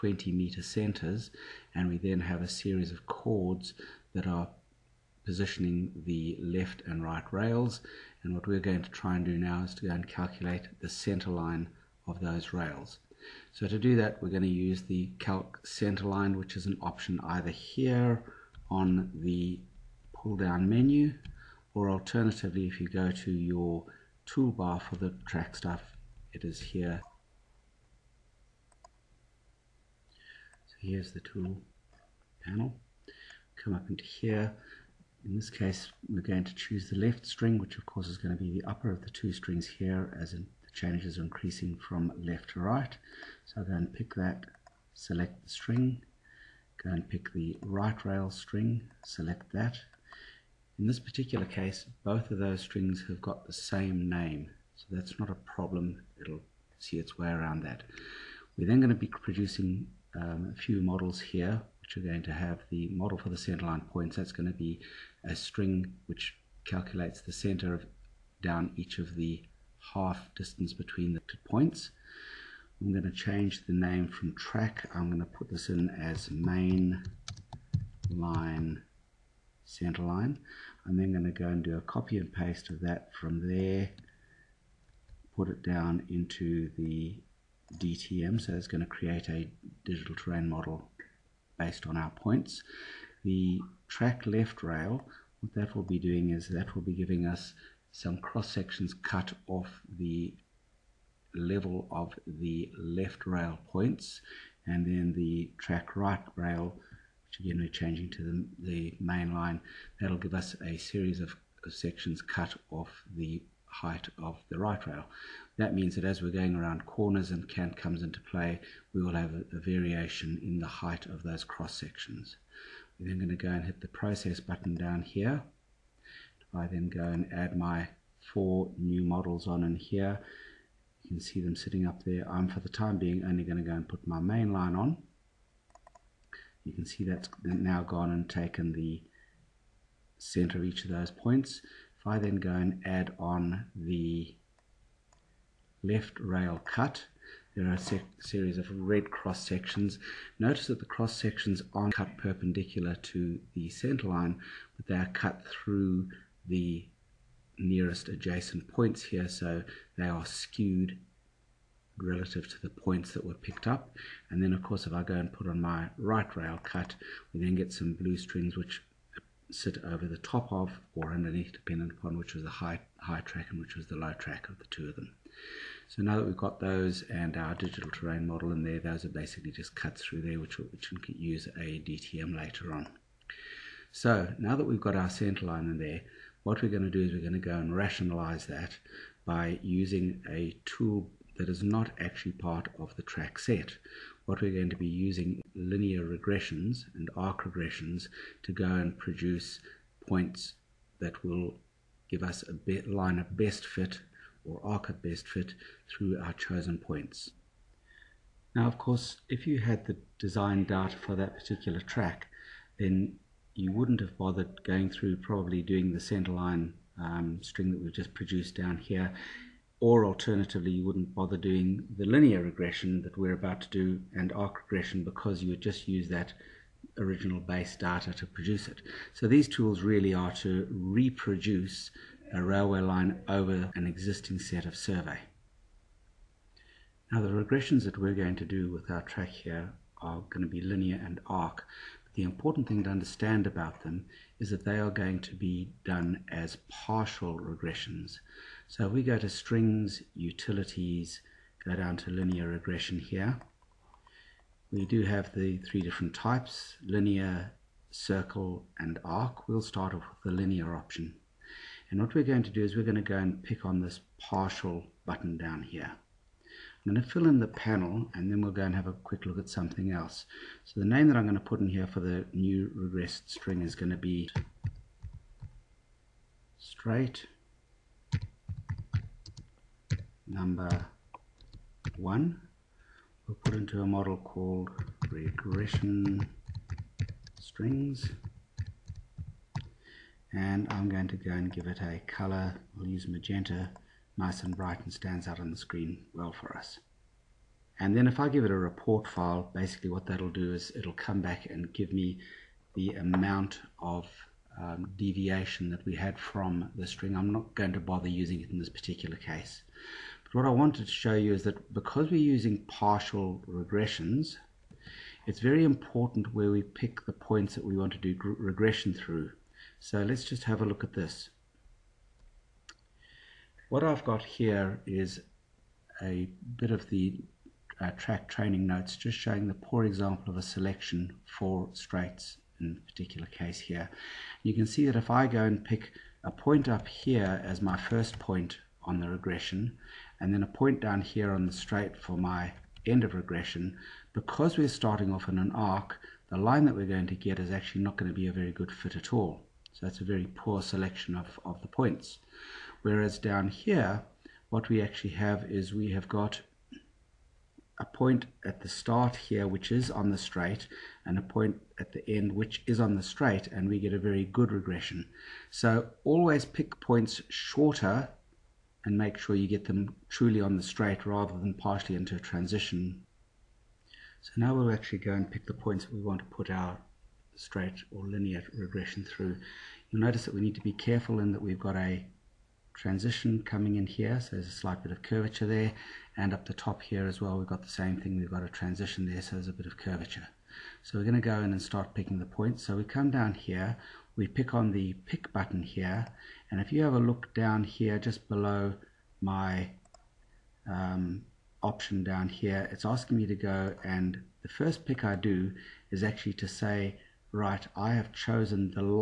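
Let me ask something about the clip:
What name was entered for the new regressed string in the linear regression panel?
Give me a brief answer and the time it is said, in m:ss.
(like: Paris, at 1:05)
straight number one, at 4:36.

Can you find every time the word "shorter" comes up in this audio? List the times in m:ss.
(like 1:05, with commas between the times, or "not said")
6:07.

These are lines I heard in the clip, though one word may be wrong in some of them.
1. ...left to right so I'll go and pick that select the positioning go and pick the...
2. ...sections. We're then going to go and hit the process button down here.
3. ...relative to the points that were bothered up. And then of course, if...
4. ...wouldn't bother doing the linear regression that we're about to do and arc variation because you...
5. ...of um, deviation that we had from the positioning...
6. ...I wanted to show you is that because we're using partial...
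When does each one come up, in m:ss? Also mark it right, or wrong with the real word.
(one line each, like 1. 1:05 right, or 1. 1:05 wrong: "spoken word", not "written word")
1. 0:42 wrong: "string", not "positioning"
2. 2:01 right
3. 2:41 wrong: "picked", not "bothered"
4. 3:40 wrong: "regression", not "variation"
5. 5:03 wrong: "string", not "positioning"
6. 5:10 right.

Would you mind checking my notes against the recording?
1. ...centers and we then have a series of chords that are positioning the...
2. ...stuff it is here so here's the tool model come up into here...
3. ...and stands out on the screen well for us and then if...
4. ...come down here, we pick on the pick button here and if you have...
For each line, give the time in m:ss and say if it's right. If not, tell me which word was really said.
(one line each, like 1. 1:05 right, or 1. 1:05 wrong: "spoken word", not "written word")
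1. 0:00 right
2. 0:25 wrong: "panel", not "model"
3. 4:54 right
4. 6:32 right.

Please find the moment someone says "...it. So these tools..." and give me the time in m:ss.
3:48.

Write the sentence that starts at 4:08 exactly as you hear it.
So we go to strings, utilities, go down to linear regression here.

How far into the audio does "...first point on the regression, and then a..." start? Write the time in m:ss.
5:37.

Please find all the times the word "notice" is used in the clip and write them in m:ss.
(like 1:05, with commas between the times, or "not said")
2:30, 6:20.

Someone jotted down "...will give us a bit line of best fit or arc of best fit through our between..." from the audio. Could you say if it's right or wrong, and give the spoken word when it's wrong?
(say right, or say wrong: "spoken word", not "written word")
wrong: "chosen", not "between".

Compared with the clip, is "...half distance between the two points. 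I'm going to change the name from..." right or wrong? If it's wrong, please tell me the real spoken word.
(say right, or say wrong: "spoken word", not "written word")
right.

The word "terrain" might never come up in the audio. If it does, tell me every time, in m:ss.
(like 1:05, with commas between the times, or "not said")
1:30, 2:57.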